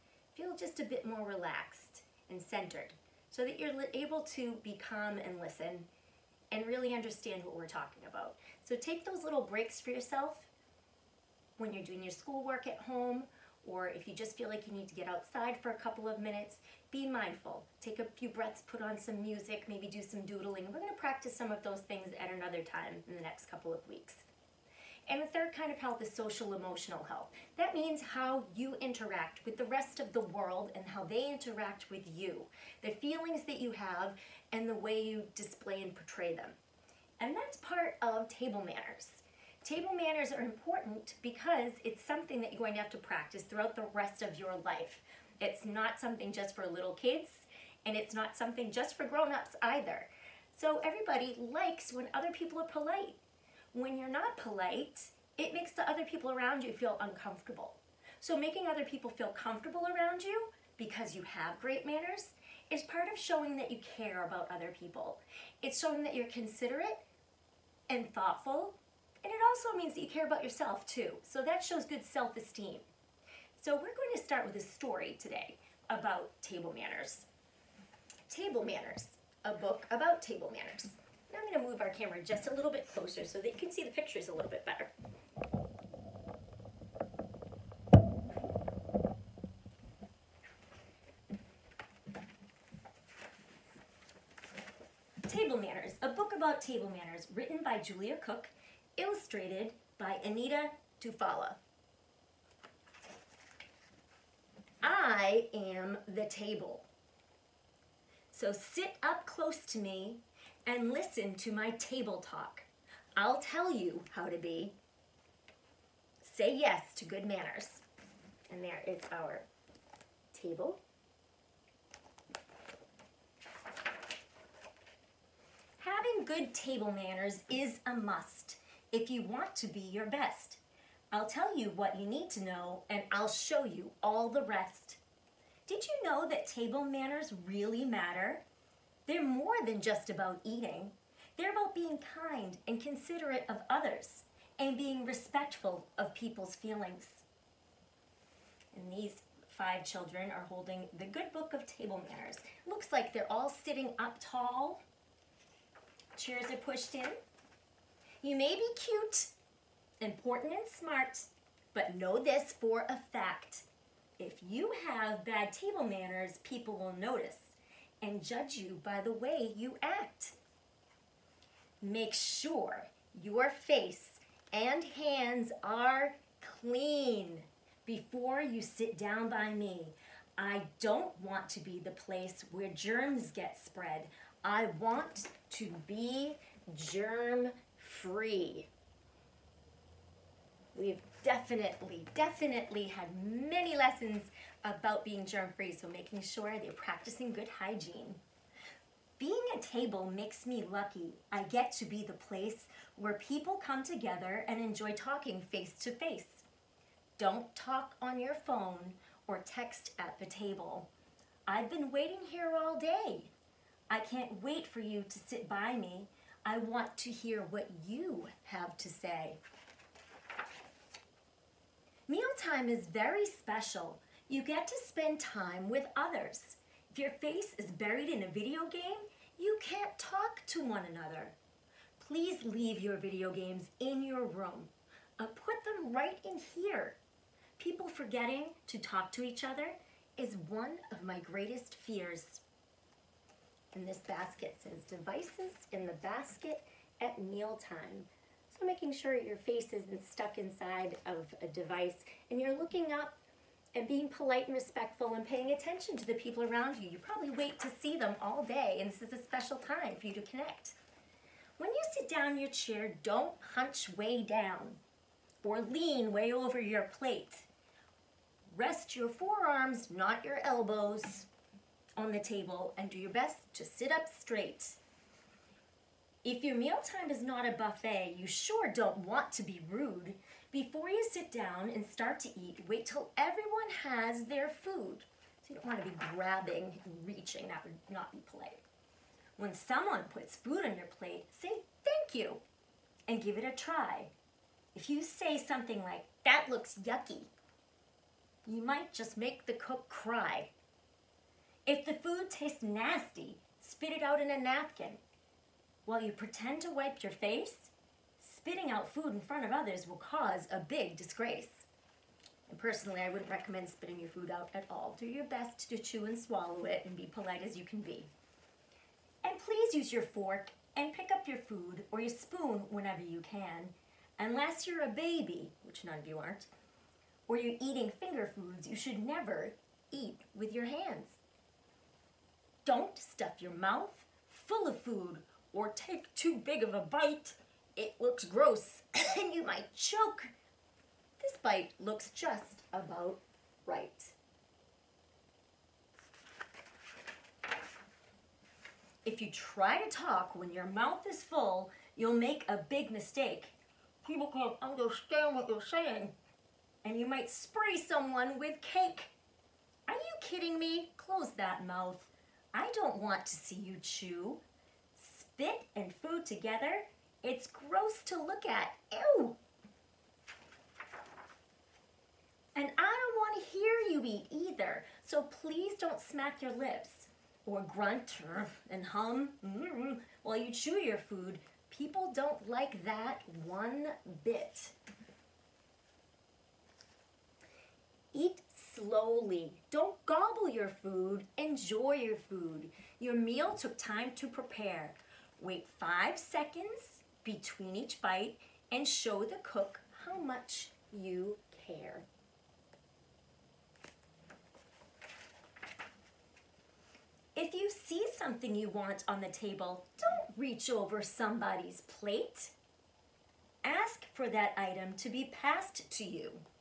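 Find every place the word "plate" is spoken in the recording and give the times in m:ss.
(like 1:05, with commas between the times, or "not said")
4:26, 4:50, 6:51.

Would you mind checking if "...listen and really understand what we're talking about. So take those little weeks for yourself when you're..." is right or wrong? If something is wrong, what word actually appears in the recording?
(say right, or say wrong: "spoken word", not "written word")
wrong: "breaks", not "weeks".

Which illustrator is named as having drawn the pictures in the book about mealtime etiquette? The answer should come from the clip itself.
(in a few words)
Anita DuFalla.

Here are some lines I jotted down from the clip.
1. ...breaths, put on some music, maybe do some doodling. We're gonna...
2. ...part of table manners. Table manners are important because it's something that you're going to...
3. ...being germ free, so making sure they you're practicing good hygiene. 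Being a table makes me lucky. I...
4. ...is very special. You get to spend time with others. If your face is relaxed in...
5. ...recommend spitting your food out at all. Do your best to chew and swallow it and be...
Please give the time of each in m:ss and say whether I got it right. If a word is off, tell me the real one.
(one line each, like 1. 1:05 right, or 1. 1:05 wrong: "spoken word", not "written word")
1. 0:18 right
2. 0:37 right
3. 3:15 right
4. 3:42 wrong: "buried", not "relaxed"
5. 5:13 right.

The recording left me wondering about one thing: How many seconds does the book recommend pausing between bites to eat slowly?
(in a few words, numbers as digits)
5.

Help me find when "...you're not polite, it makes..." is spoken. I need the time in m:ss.
0:53.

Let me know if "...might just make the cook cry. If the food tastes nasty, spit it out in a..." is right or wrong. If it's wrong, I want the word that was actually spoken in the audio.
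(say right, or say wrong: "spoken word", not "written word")
right.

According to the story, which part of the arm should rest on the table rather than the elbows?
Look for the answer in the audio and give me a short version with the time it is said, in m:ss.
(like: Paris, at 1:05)
Forearms, at 4:29.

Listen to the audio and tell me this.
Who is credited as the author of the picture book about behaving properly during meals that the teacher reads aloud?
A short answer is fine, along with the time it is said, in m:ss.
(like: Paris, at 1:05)
Julia Cook, at 1:37.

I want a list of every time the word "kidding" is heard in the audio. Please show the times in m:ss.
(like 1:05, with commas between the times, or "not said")
6:00.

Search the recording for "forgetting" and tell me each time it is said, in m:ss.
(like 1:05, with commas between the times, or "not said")
3:57.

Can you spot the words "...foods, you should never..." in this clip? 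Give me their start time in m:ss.
5:28.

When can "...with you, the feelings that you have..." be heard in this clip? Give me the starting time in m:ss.
0:31.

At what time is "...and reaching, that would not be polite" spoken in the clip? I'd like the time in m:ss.
4:46.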